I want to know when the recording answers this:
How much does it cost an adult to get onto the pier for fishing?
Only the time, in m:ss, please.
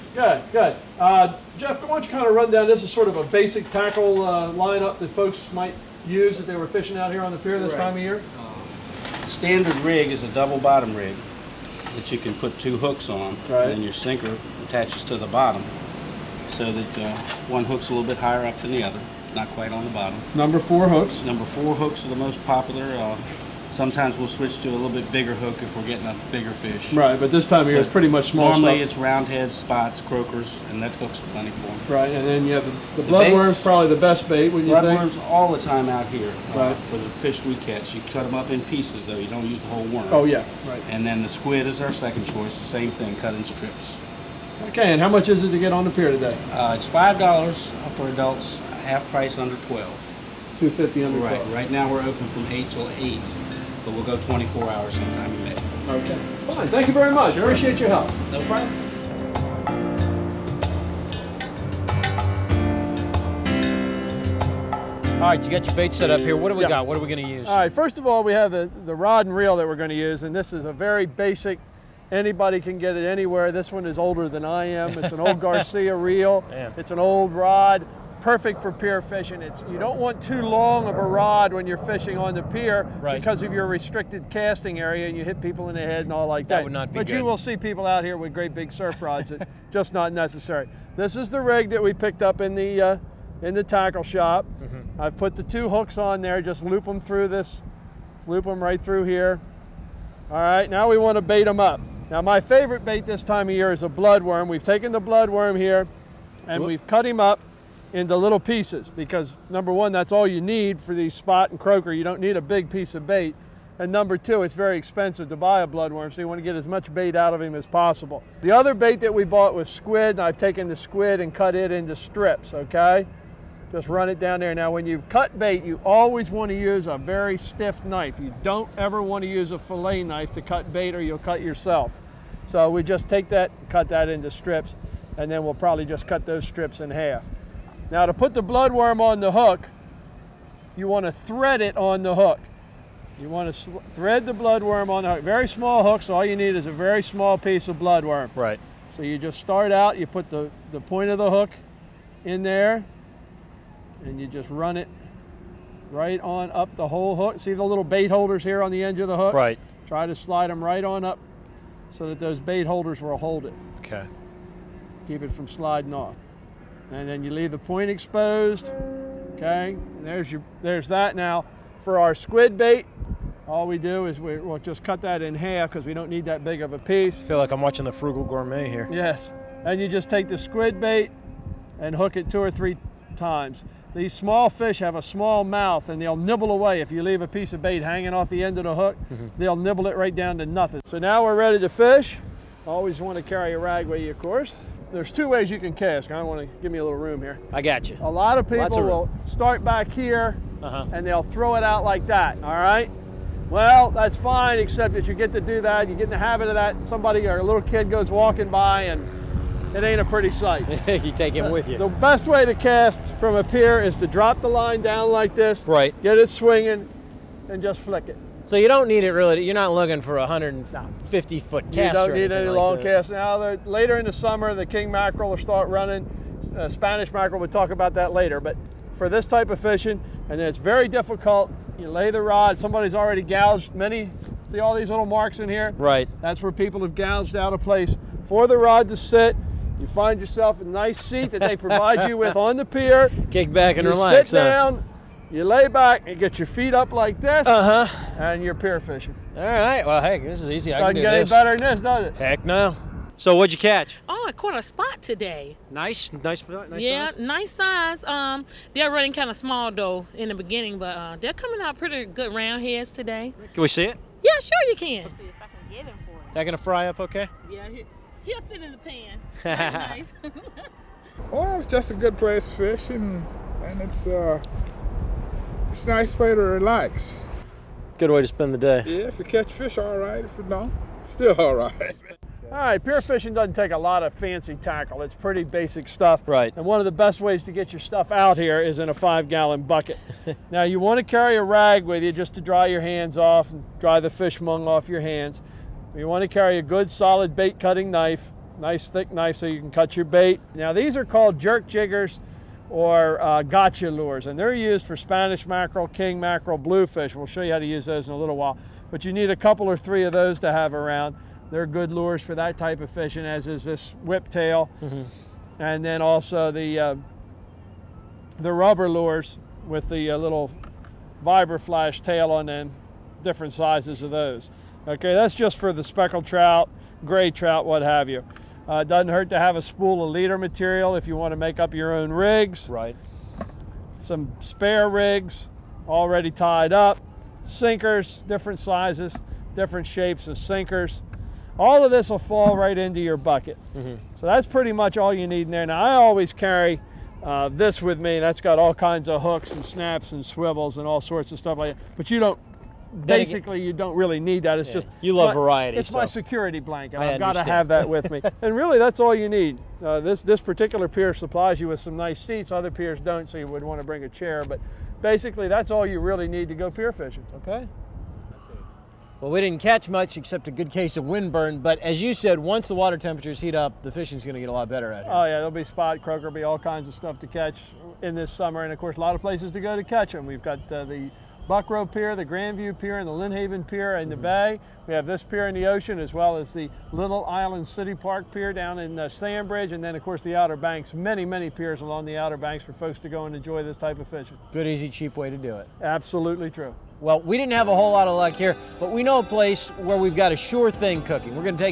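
0:46.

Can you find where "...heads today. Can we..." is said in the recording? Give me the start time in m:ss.
4:22.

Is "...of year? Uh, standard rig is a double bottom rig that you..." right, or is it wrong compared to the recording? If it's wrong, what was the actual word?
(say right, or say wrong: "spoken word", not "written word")
right.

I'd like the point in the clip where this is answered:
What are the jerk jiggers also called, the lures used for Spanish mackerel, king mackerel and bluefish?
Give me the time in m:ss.
5:03.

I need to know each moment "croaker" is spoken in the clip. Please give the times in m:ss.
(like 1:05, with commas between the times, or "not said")
0:29, 1:51, 6:16.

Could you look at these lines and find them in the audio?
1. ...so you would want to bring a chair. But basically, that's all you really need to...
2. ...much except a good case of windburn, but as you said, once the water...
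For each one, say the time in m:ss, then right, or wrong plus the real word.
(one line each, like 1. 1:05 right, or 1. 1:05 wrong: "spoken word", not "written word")
1. 6:03 right
2. 6:09 right.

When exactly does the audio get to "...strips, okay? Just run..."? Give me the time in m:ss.
2:01.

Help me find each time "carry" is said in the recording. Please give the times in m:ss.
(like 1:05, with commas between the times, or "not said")
3:13, 4:51, 4:56, 5:46.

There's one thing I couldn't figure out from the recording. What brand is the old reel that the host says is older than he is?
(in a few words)
Garcia.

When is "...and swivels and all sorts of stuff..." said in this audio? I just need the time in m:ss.
5:50.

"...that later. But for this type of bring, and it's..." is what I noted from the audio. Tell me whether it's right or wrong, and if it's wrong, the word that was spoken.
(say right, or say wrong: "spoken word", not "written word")
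wrong: "fishing", not "bring".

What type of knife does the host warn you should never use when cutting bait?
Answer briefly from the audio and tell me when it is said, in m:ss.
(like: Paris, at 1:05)
Fillet knife, at 2:09.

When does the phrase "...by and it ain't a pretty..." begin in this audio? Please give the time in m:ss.
3:28.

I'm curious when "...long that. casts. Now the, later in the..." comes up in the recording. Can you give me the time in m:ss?
3:42.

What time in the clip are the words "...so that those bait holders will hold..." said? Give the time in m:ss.
2:41.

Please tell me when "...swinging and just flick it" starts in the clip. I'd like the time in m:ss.
3:36.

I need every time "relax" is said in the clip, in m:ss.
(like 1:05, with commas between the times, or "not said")
4:03, 4:36.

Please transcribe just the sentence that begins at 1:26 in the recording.
That would not be But good.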